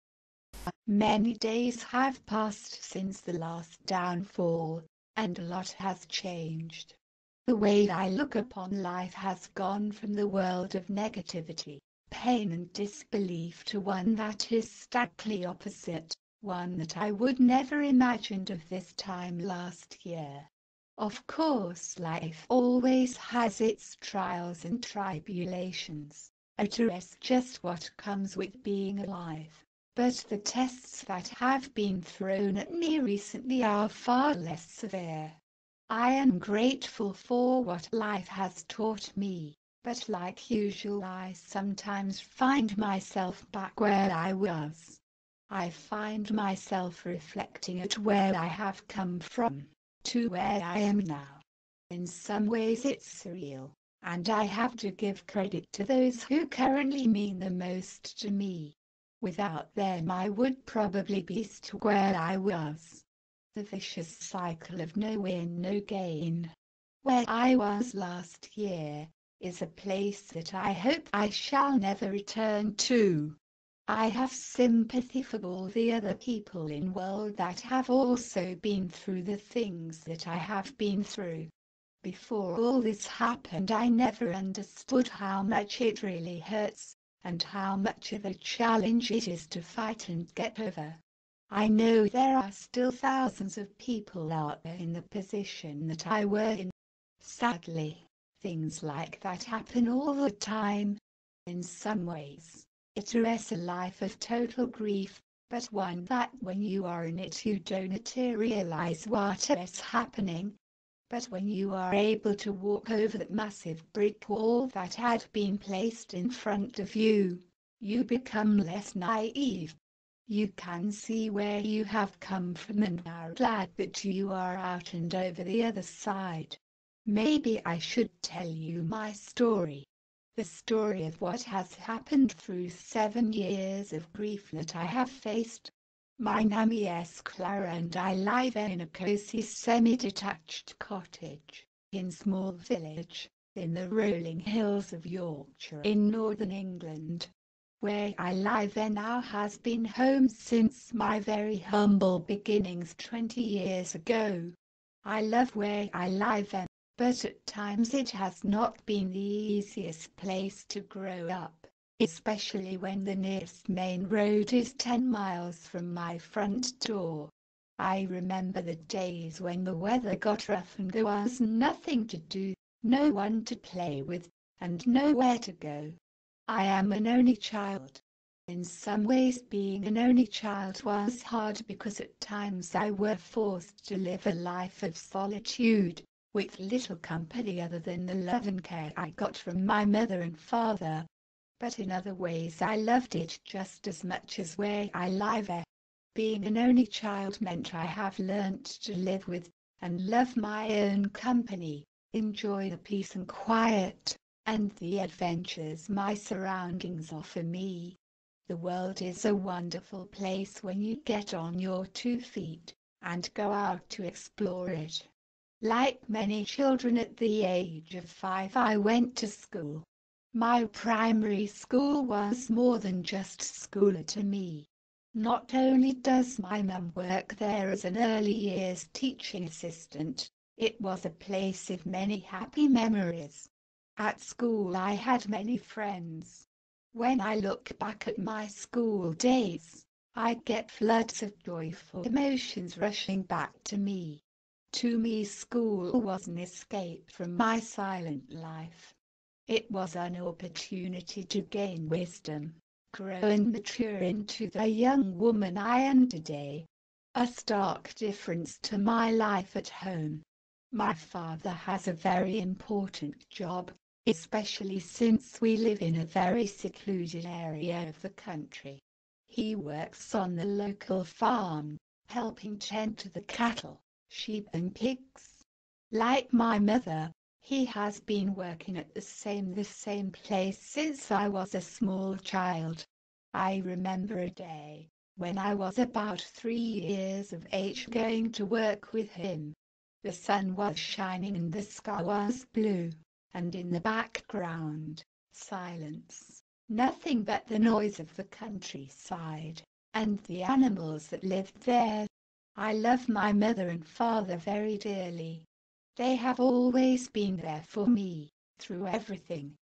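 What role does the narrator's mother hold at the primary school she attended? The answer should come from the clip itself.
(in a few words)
early years teaching assistant.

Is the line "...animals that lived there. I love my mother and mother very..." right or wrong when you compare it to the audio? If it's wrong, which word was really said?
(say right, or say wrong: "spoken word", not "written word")
wrong: "father", not "mother".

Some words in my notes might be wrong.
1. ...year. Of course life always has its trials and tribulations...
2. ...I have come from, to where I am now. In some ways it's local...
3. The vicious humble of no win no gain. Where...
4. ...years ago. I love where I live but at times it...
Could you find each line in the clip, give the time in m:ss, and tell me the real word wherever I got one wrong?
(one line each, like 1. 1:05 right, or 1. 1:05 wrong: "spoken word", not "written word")
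1. 0:20 right
2. 0:48 wrong: "surreal", not "local"
3. 1:03 wrong: "cycle", not "humble"
4. 2:33 right.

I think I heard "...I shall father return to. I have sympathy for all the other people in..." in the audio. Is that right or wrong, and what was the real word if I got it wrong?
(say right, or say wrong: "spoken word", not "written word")
wrong: "never", not "father".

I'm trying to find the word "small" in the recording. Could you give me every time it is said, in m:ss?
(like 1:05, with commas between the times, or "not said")
2:22, 4:41.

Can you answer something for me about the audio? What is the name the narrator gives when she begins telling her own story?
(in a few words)
Clara.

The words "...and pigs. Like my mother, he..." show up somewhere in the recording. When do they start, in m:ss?
4:34.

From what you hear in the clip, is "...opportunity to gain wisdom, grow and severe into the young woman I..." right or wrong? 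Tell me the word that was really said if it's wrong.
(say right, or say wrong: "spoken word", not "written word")
wrong: "mature", not "severe".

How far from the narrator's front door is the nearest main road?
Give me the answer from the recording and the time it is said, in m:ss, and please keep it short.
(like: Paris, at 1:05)
10 miles, at 2:44.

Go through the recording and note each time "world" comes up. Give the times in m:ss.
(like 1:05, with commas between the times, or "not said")
0:10, 1:16, 3:28.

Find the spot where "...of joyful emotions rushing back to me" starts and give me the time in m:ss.
4:01.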